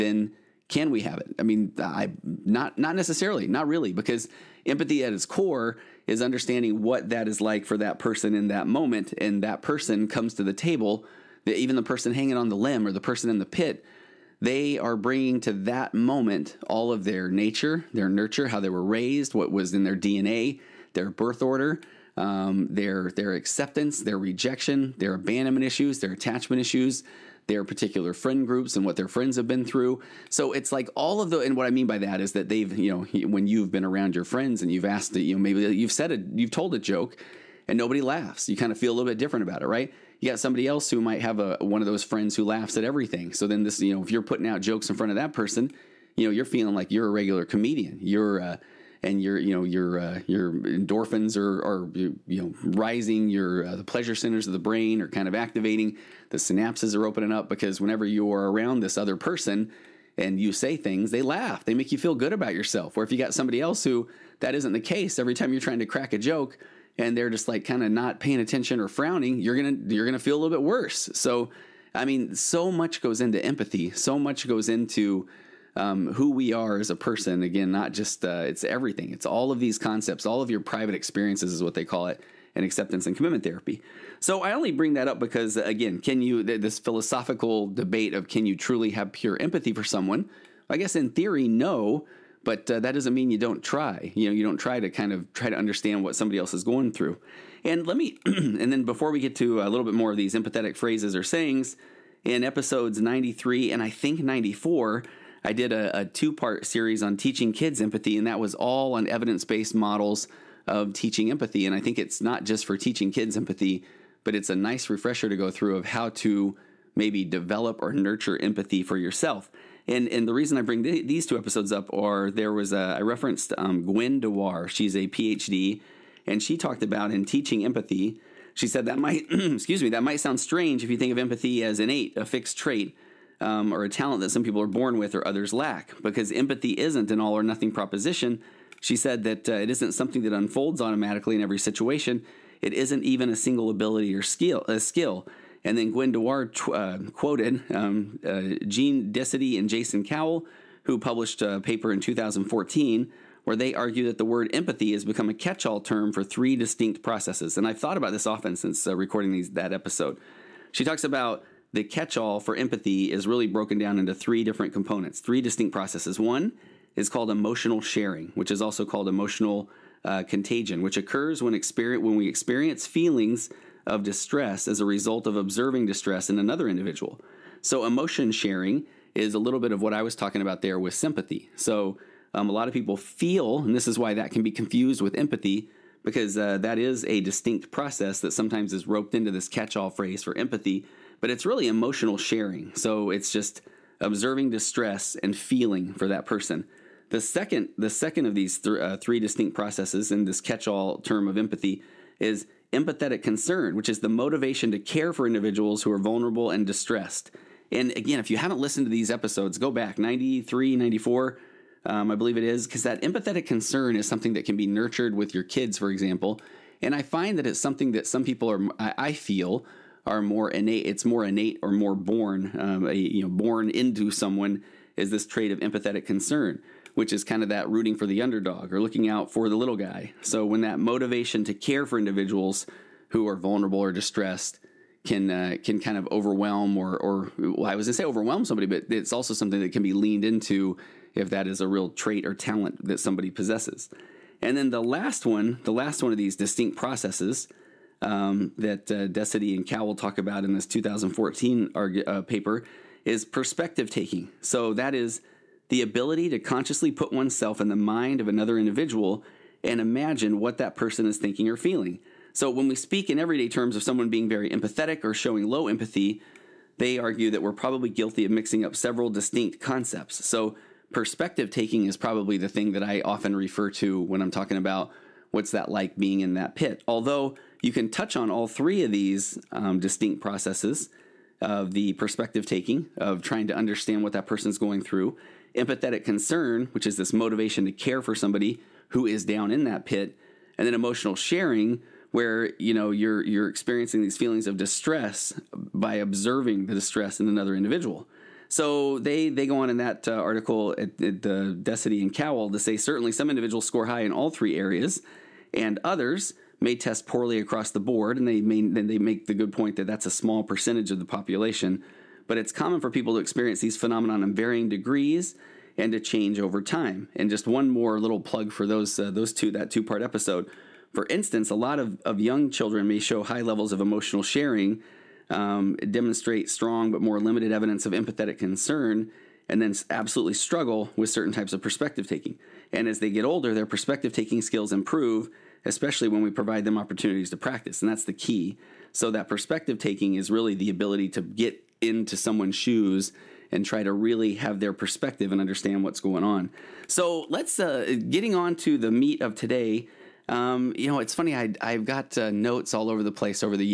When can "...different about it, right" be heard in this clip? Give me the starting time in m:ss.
0:39.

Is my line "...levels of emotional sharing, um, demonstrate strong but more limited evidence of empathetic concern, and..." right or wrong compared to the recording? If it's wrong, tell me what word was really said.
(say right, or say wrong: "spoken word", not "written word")
right.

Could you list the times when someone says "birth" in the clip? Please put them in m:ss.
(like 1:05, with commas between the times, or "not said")
0:21.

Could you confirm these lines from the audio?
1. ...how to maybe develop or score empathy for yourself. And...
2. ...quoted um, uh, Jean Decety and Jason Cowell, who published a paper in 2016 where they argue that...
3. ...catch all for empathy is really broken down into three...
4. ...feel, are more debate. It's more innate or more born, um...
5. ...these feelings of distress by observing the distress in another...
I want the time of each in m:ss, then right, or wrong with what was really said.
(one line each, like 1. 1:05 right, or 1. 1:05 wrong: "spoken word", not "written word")
1. 1:55 wrong: "nurture", not "score"
2. 2:27 wrong: "2014", not "2016"
3. 2:41 right
4. 3:39 wrong: "innate", not "debate"
5. 4:54 right.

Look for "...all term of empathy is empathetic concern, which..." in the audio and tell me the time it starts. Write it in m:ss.
3:20.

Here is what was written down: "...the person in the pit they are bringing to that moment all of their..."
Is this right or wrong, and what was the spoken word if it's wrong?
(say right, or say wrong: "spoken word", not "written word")
right.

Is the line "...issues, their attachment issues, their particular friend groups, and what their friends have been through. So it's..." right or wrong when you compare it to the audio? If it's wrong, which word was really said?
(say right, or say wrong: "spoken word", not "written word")
right.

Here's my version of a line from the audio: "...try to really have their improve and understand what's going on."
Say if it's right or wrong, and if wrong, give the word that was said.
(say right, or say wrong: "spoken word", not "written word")
wrong: "perspective", not "improve".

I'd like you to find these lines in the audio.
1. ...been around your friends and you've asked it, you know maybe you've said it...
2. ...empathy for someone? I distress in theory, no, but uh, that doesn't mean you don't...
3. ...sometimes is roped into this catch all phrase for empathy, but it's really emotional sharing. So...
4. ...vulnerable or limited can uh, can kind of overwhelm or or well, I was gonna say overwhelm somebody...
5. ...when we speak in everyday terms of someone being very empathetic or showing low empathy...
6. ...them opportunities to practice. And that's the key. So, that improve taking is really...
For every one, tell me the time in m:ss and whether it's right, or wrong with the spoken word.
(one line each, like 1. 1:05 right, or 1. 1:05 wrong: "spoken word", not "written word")
1. 0:33 right
2. 1:29 wrong: "guess", not "distress"
3. 3:08 right
4. 3:53 wrong: "distressed", not "limited"
5. 4:22 right
6. 5:36 wrong: "perspective", not "improve".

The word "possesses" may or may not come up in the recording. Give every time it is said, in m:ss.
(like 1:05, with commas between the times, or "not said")
4:03.